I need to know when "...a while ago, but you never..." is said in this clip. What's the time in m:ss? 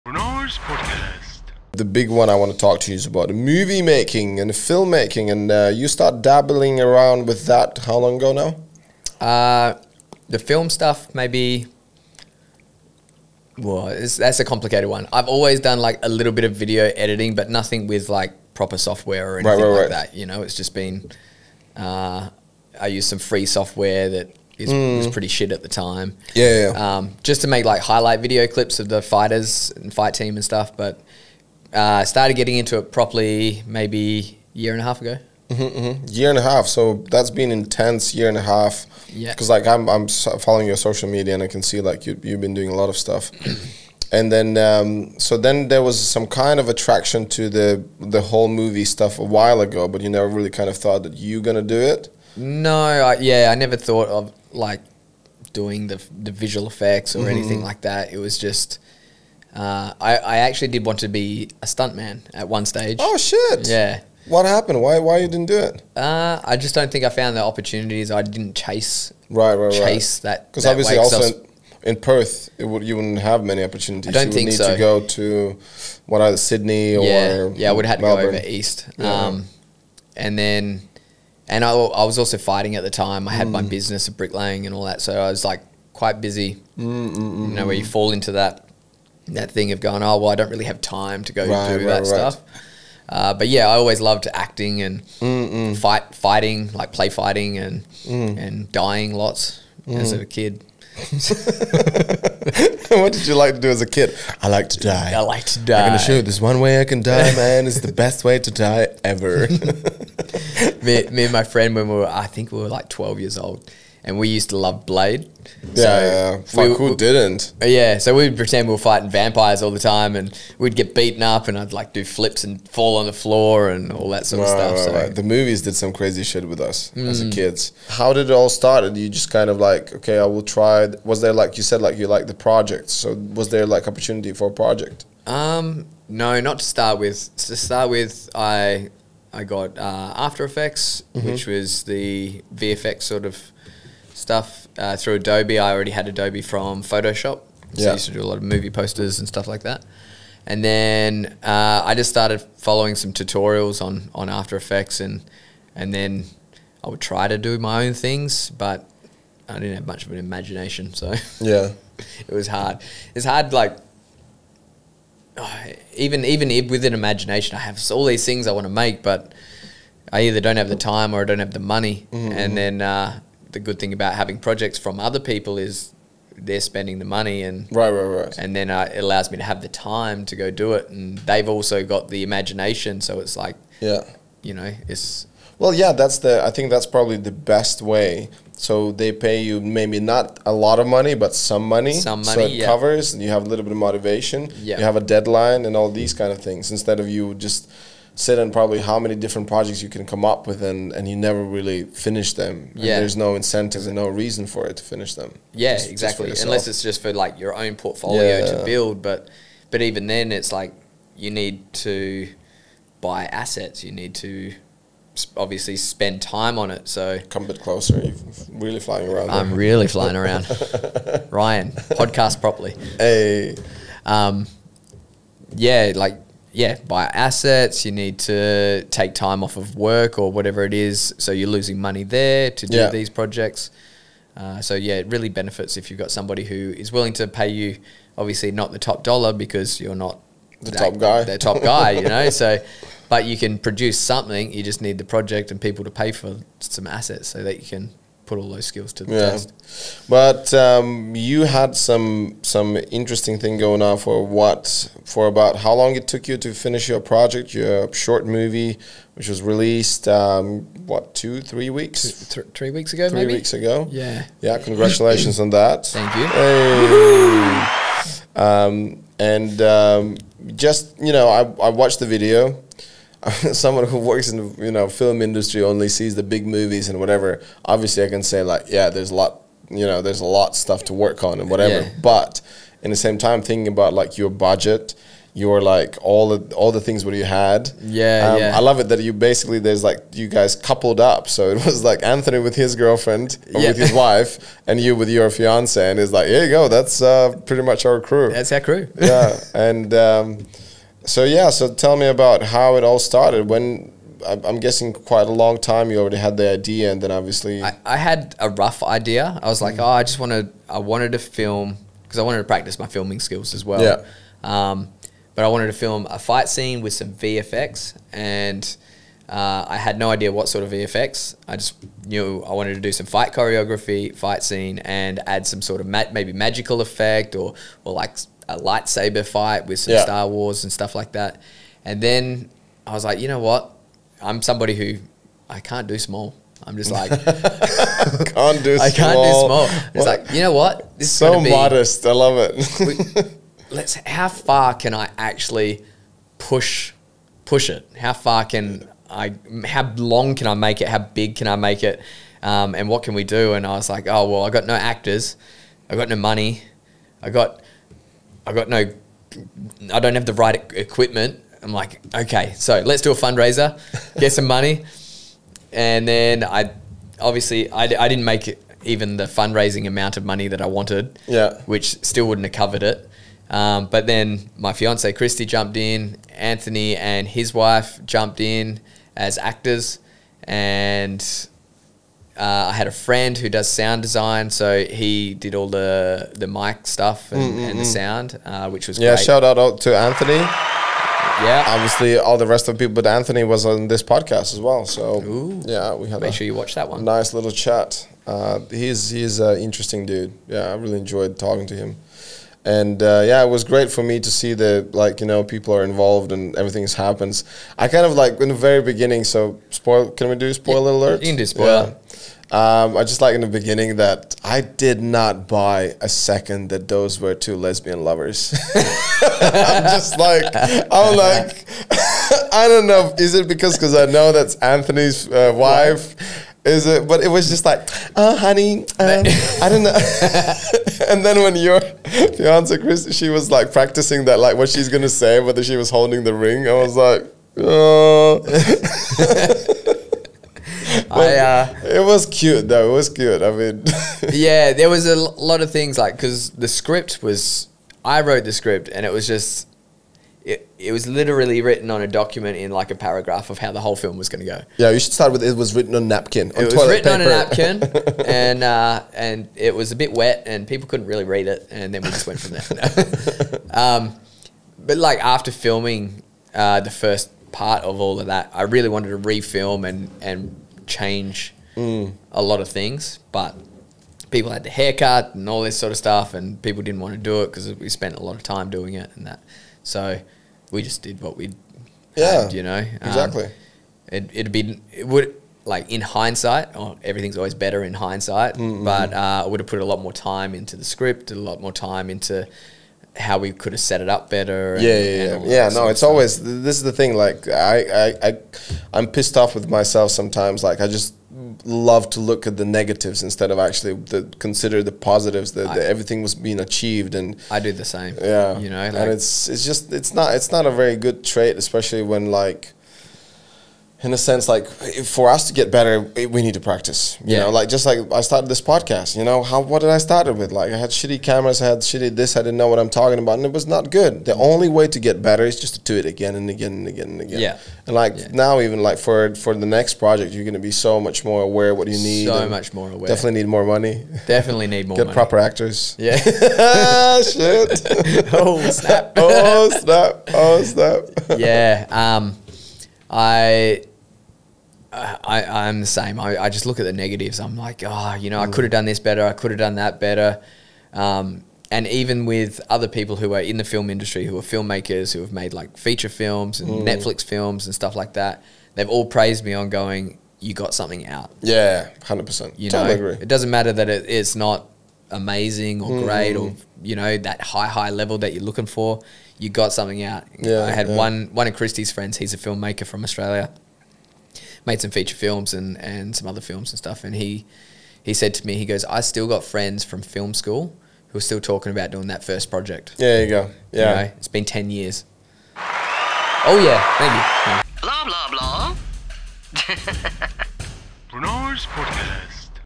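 0:49.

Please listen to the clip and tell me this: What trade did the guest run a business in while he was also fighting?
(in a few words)
bricklaying.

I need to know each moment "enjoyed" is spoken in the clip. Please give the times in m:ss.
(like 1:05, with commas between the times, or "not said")
6:40.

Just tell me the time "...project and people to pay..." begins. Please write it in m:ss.
4:05.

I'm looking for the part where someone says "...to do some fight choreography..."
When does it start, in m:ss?
5:22.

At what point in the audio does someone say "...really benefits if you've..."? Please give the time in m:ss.
3:55.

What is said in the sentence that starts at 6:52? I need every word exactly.
Um, I just like in the beginning that I did not buy a second that those were two lesbian lovers.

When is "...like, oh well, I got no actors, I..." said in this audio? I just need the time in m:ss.
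5:53.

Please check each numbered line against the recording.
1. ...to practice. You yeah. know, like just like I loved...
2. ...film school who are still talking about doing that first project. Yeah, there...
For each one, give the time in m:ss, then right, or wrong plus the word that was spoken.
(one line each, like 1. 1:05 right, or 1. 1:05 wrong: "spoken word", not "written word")
1. 8:36 wrong: "started", not "loved"
2. 9:40 right.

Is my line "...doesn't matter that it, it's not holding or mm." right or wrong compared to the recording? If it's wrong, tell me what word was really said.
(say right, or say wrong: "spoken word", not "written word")
wrong: "amazing", not "holding".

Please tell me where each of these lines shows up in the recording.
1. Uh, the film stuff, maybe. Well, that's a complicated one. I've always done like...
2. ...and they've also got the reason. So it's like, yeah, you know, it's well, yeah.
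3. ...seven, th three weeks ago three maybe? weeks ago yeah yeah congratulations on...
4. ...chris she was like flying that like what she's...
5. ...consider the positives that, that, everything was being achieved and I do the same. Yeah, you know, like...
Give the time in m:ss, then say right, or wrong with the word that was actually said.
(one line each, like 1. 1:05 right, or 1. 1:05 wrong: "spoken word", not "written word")
1. 0:09 right
2. 3:00 wrong: "imagination", not "reason"
3. 4:22 wrong: "two", not "seven"
4. 7:12 wrong: "practicing", not "flying"
5. 8:24 right.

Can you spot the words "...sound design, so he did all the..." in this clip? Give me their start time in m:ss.
6:23.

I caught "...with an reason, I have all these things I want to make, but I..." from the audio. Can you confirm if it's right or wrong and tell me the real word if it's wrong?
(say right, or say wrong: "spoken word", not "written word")
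wrong: "imagination", not "reason".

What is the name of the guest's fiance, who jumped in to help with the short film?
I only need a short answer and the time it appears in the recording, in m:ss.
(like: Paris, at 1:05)
Christy, at 6:15.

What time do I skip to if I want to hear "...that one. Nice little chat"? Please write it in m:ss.
6:36.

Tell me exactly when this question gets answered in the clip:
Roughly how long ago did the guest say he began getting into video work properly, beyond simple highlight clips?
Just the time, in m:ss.
0:34.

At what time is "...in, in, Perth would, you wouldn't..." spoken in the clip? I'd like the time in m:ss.
1:11.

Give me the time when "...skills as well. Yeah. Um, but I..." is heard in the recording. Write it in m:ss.
5:13.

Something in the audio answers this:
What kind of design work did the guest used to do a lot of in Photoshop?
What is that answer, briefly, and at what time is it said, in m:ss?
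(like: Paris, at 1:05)
movie posters, at 2:28.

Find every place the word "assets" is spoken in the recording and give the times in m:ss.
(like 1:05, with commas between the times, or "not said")
3:33, 3:47, 4:06.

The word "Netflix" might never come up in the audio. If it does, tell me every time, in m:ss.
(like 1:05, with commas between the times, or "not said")
9:16.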